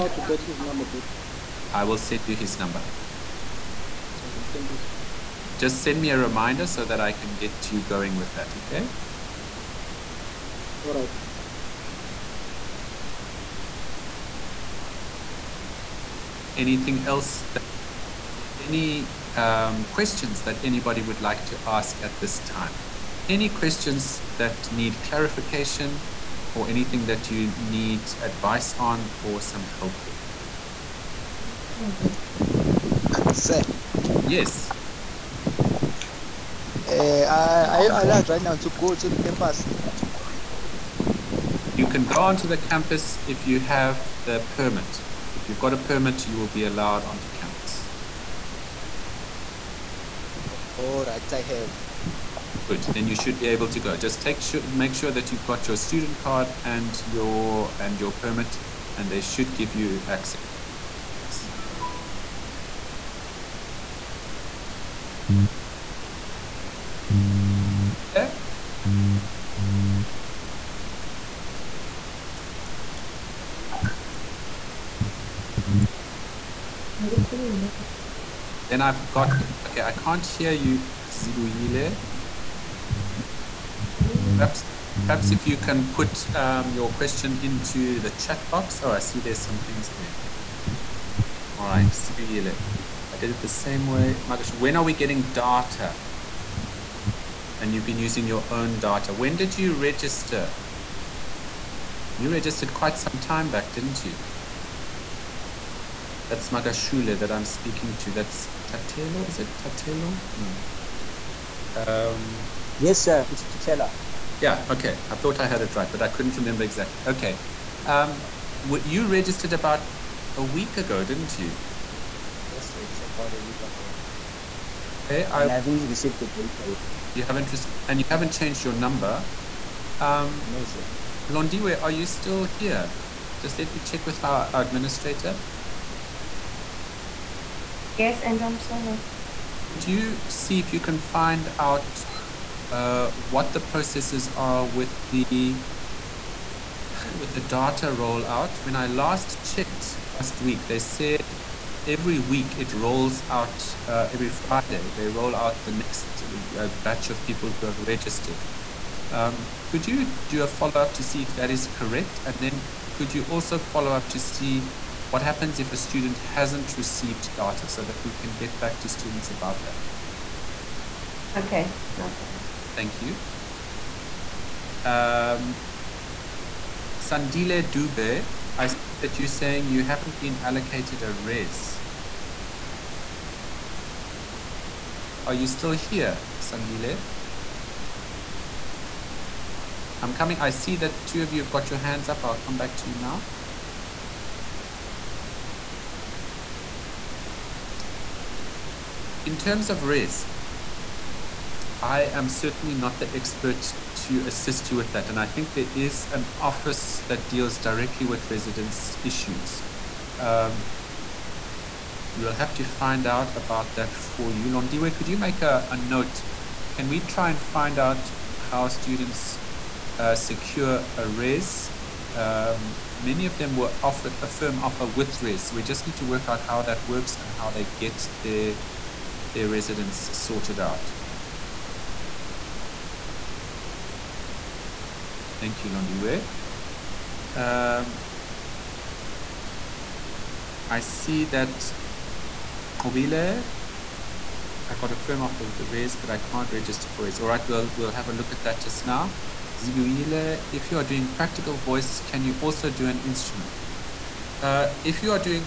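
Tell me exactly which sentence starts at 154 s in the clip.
They roll out the next uh, batch of people who have registered.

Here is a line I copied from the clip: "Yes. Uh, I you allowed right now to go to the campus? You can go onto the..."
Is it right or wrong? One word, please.
right.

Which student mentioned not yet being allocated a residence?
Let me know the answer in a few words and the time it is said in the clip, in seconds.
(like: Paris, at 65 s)
Sandile Dube, at 176 s.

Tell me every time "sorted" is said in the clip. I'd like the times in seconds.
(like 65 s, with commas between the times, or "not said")
230 s.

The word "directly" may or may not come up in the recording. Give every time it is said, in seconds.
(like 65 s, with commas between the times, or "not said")
207 s.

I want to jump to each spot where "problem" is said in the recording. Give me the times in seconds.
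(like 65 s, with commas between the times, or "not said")
172 s.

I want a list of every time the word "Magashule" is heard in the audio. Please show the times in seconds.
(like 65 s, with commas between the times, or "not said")
106 s.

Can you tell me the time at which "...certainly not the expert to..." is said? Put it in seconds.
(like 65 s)
202 s.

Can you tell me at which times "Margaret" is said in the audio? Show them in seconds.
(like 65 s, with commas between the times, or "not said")
94 s.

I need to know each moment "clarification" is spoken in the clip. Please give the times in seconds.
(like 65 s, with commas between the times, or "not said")
25 s.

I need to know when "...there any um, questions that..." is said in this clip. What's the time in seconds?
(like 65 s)
18 s.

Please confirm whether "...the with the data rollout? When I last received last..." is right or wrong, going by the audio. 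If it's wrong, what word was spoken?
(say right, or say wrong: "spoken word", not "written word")
wrong: "checked", not "received".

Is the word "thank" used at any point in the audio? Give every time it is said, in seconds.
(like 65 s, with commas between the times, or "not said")
4 s, 172 s, 235 s.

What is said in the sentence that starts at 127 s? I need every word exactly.
You haven't, and you haven't changed your number.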